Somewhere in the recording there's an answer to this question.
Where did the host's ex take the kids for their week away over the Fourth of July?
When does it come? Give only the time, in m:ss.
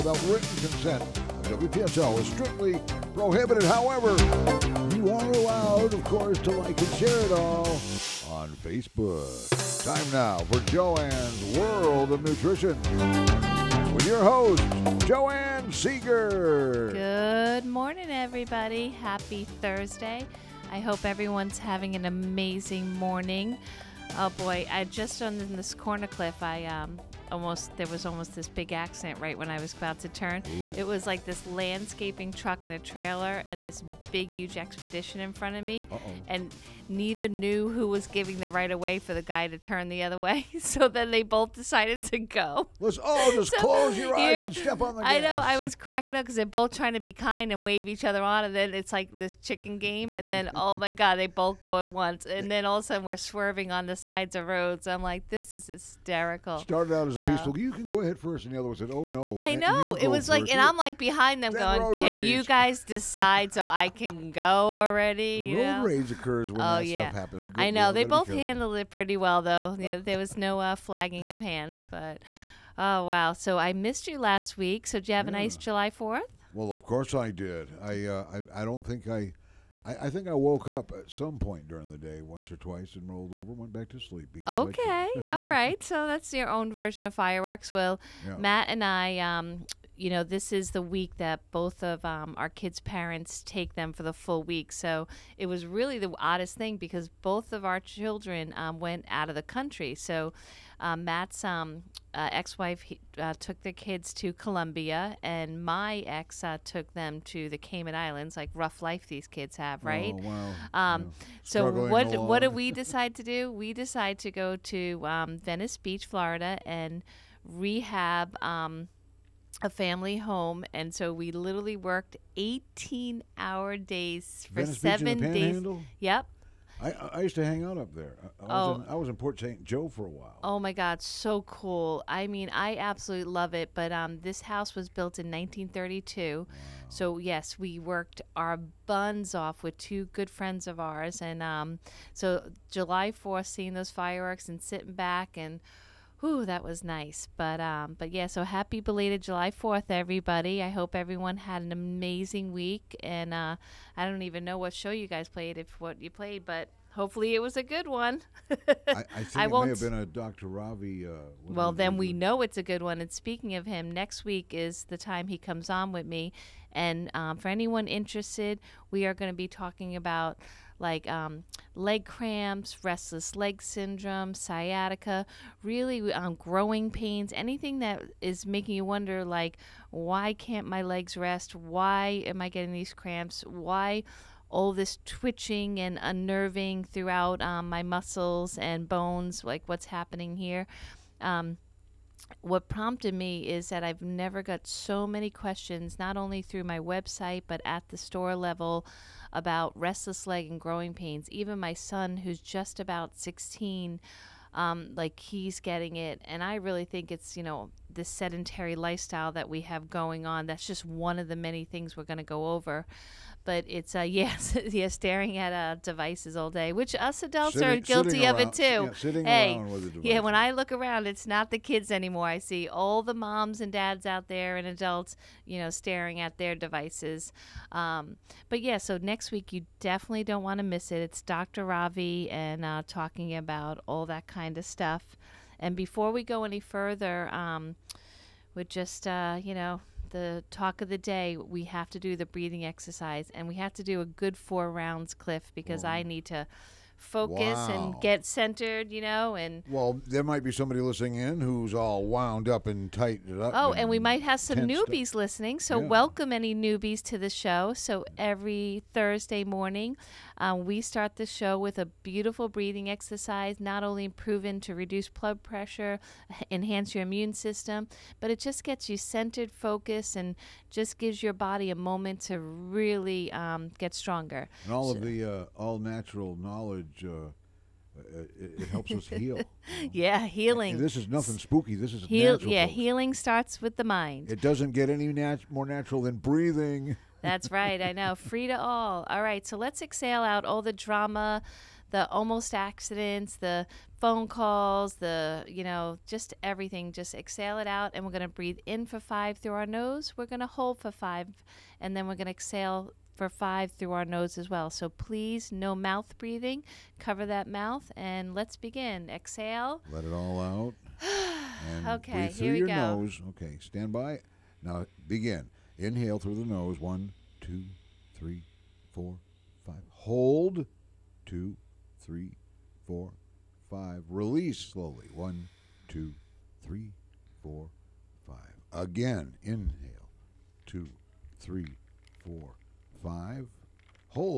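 1:47.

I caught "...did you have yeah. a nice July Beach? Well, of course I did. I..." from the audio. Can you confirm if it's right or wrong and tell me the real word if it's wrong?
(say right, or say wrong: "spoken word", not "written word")
wrong: "Fourth", not "Beach".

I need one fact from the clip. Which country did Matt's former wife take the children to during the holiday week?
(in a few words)
Colombia.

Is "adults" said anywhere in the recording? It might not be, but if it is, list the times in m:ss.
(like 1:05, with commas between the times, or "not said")
3:37, 3:44.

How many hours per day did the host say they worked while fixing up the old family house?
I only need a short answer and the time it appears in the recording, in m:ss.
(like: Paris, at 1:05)
18, at 2:02.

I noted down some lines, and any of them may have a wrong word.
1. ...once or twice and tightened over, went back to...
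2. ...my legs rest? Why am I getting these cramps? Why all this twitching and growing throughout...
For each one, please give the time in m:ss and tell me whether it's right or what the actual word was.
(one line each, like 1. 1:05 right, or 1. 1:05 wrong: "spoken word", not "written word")
1. 1:22 wrong: "rolled", not "tightened"
2. 3:00 wrong: "unnerving", not "growing".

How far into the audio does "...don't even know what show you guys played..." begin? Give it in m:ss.
2:34.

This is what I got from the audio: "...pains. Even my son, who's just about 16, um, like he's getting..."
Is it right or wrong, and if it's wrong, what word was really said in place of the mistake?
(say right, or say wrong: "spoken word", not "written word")
right.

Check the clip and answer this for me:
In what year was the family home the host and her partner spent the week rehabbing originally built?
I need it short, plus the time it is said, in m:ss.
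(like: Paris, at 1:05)
1932, at 2:15.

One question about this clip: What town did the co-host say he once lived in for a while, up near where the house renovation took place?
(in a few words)
Port St. Joe.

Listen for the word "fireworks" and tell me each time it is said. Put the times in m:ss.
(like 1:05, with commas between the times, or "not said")
1:27, 2:23.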